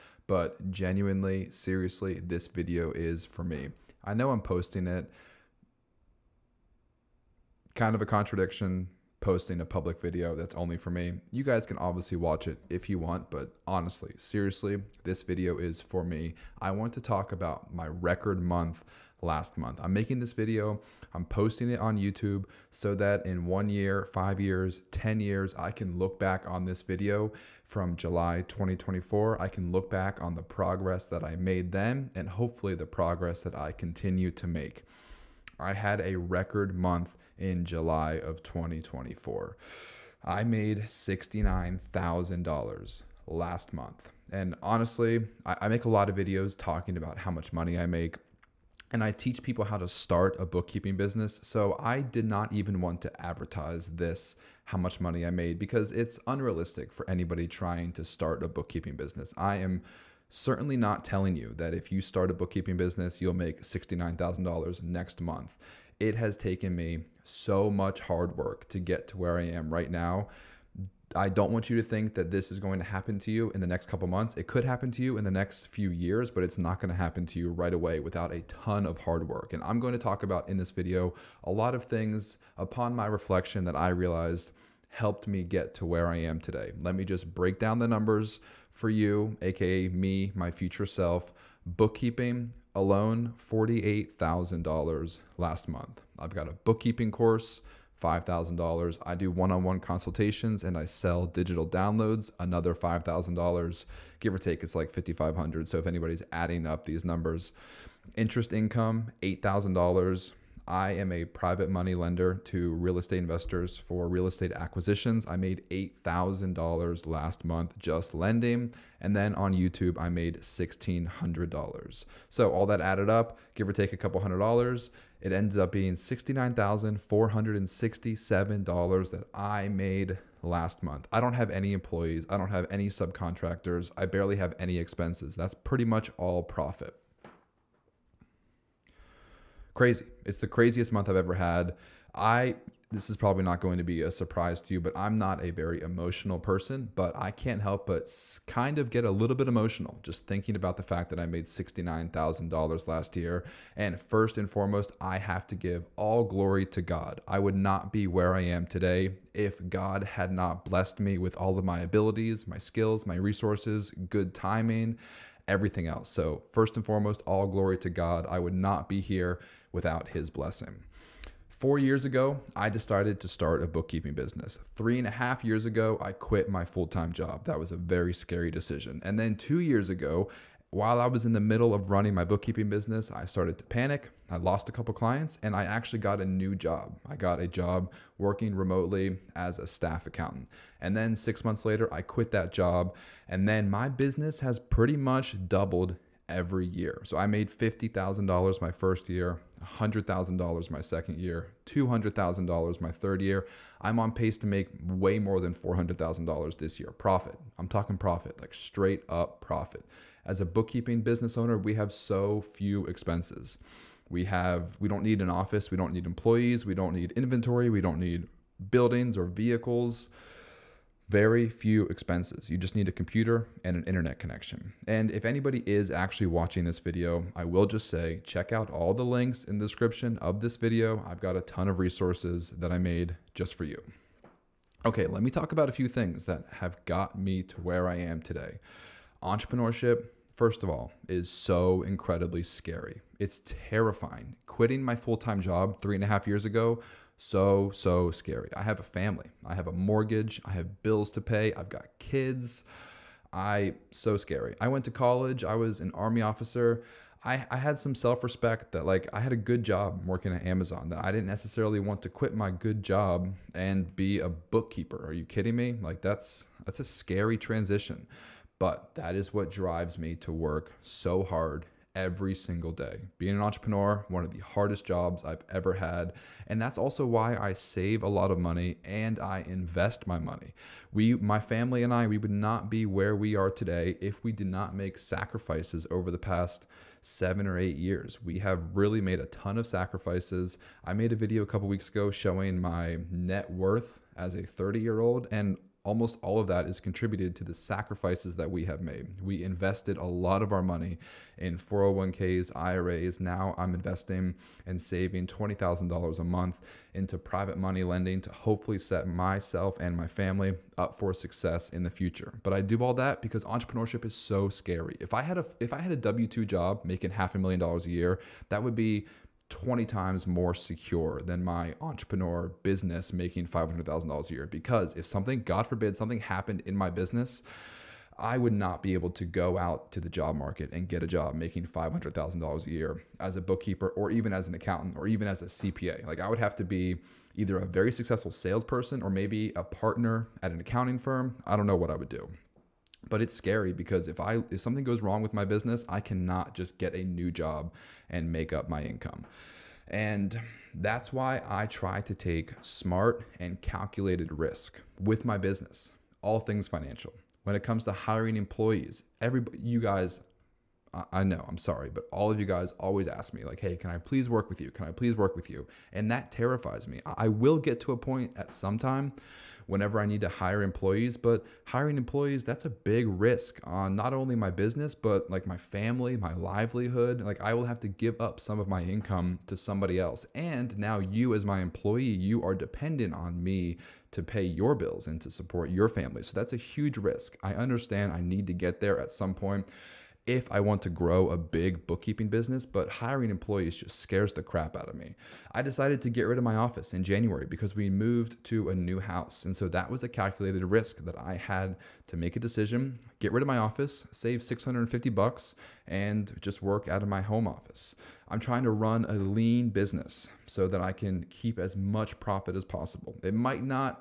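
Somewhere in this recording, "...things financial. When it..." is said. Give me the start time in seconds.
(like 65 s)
356 s.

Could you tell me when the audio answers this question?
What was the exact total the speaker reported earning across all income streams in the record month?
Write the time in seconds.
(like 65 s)
125 s.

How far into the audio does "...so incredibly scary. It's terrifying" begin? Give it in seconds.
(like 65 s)
241 s.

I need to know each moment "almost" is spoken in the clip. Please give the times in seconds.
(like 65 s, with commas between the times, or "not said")
295 s.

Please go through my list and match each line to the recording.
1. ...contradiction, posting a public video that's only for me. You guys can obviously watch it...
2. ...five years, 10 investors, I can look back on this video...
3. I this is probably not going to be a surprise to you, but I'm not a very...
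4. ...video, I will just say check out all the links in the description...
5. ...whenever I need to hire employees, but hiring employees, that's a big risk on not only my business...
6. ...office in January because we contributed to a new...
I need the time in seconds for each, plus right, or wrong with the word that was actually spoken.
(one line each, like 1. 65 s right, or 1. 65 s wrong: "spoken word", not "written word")
1. 8 s right
2. 24 s wrong: "years", not "investors"
3. 142 s right
4. 226 s right
5. 369 s right
6. 396 s wrong: "moved", not "contributed".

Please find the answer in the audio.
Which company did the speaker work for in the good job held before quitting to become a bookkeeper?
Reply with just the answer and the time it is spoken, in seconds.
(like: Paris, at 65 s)
Amazon, at 260 s.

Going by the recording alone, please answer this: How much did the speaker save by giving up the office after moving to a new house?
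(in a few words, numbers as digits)
$650.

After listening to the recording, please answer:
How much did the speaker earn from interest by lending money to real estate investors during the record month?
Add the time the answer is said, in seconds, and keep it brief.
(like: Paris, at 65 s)
$8,000, at 108 s.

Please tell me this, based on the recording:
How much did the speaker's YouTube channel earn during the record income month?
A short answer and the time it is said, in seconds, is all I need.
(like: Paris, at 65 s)
$1,600, at 120 s.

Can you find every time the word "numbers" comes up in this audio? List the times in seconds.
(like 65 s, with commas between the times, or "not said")
87 s, 107 s.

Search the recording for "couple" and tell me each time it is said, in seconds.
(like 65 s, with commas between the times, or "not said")
73 s, 123 s, 184 s, 291 s.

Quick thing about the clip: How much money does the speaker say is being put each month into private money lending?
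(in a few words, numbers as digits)
$20,000.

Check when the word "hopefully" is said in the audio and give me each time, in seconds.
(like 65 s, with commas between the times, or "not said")
32 s, 308 s.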